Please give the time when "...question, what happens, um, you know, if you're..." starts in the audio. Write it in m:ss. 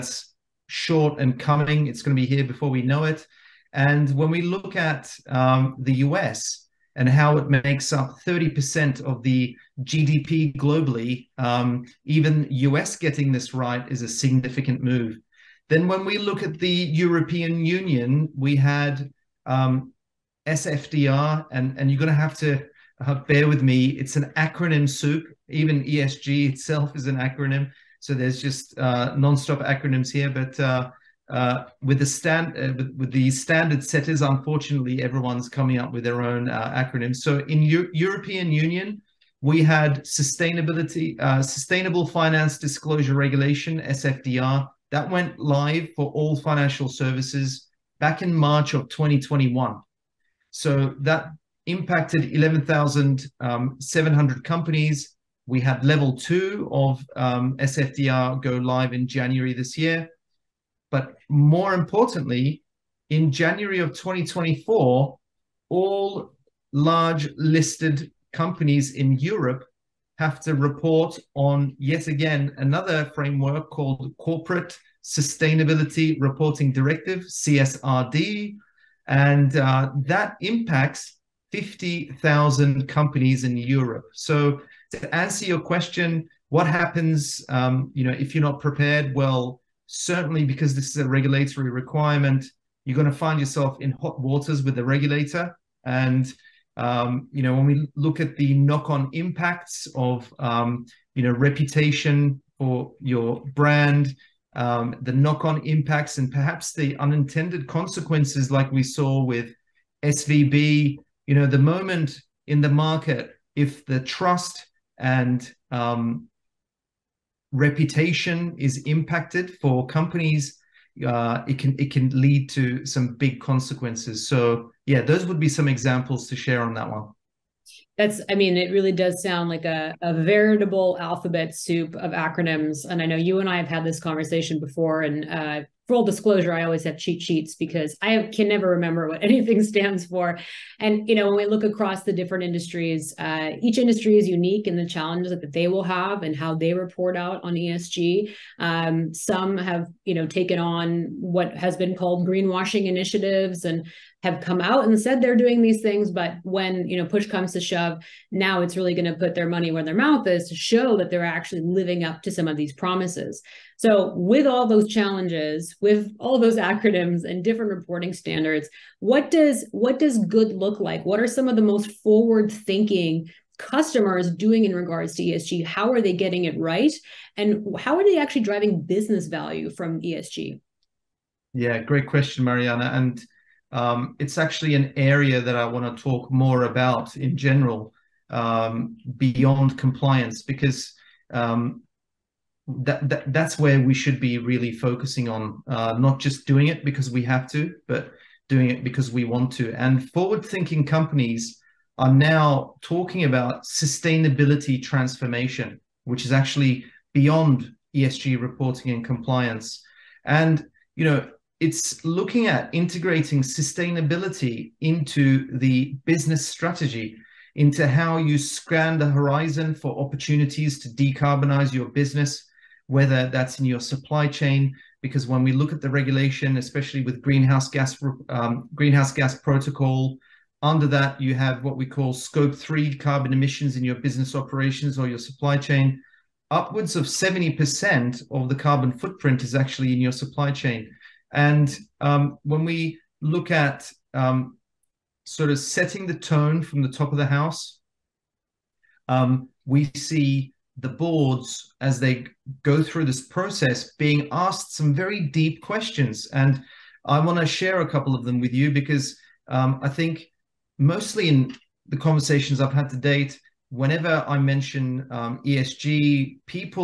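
1:25.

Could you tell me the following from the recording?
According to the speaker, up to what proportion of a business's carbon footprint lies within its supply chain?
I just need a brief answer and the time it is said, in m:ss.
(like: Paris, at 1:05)
70%, at 3:57.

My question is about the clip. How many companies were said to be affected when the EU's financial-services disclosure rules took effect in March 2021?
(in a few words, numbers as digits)
11,700.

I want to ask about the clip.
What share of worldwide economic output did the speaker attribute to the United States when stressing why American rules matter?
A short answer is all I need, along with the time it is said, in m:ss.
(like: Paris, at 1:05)
30%, at 0:08.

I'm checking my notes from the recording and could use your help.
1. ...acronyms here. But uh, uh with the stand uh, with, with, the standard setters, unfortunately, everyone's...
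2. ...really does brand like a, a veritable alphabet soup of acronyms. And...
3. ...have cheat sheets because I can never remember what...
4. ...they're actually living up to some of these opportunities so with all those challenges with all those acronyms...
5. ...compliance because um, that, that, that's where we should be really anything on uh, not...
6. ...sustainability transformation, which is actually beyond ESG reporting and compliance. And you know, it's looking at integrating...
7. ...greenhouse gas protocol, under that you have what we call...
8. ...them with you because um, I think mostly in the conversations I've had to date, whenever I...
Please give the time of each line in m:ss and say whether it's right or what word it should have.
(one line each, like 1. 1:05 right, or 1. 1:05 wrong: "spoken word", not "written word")
1. 0:29 right
2. 2:08 wrong: "sound", not "brand"
3. 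2:16 right
4. 2:41 wrong: "promises", not "opportunities"
5. 3:09 wrong: "focusing", not "anything"
6. 3:23 right
7. 3:48 right
8. 4:18 right.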